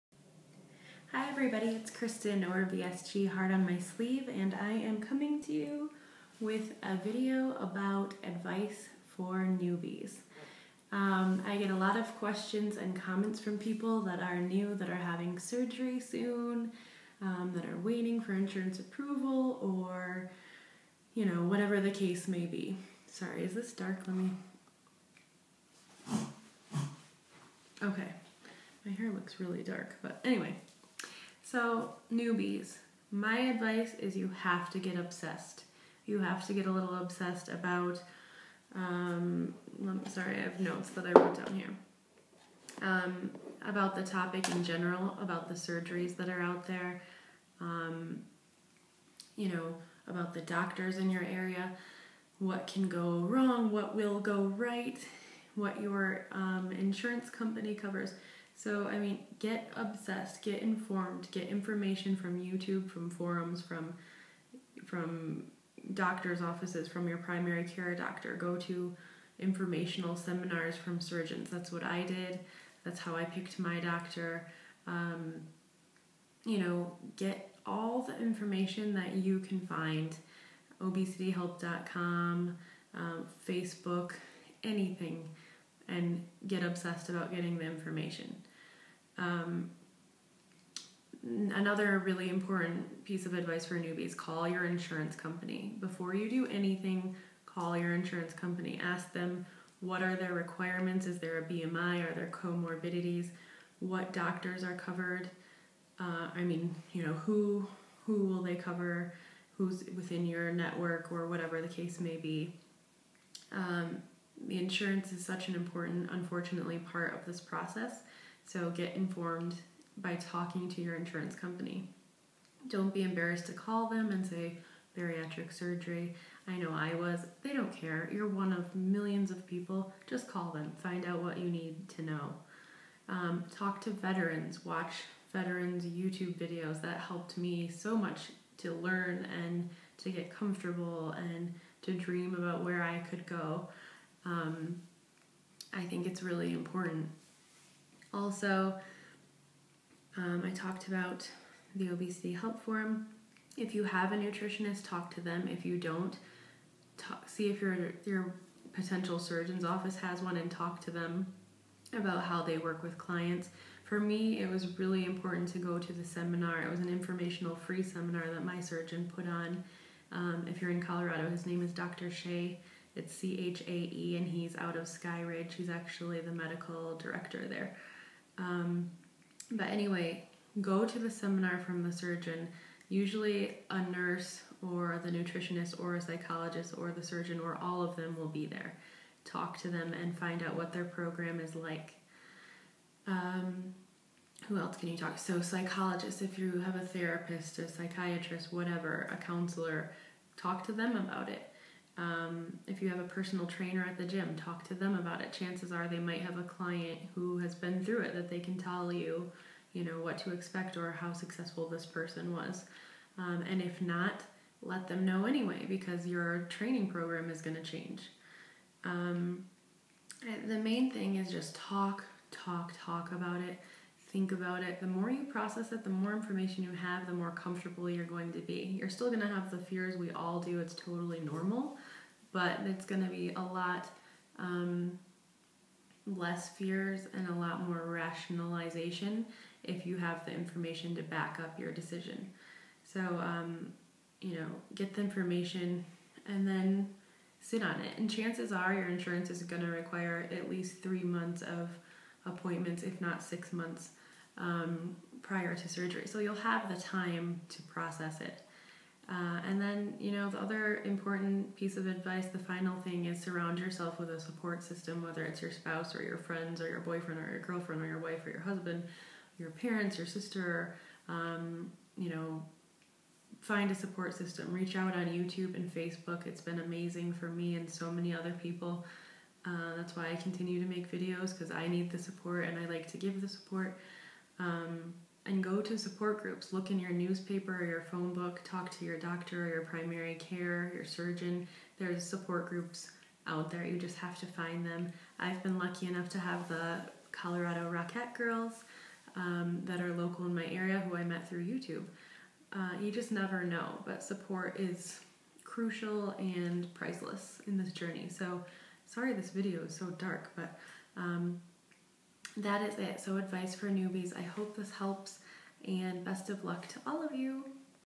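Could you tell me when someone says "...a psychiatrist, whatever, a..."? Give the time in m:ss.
3:17.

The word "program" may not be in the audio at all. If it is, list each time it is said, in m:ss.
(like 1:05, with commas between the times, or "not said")
3:10, 3:36.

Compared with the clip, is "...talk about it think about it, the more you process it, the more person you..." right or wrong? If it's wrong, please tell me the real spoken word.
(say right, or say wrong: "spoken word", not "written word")
wrong: "information", not "person".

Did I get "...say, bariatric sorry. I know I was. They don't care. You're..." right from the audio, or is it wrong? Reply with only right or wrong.
wrong.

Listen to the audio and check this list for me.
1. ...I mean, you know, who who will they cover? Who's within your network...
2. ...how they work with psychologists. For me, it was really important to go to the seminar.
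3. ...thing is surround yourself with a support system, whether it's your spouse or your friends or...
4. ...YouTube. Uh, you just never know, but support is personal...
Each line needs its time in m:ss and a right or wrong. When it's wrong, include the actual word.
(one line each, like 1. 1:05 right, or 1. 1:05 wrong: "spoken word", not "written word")
1. 1:46 right
2. 2:42 wrong: "clients", not "psychologists"
3. 4:22 right
4. 5:01 wrong: "crucial", not "personal".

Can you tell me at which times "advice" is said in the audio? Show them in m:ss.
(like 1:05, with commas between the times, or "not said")
0:08, 0:33, 1:33, 4:21, 5:13.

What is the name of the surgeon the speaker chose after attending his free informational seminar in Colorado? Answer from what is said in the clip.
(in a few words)
Dr. Chae.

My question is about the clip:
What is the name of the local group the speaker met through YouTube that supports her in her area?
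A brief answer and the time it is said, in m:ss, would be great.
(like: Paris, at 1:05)
Colorado Rockette Girls, at 4:57.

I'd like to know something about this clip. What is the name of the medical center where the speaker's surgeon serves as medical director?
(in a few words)
Sky Ridge.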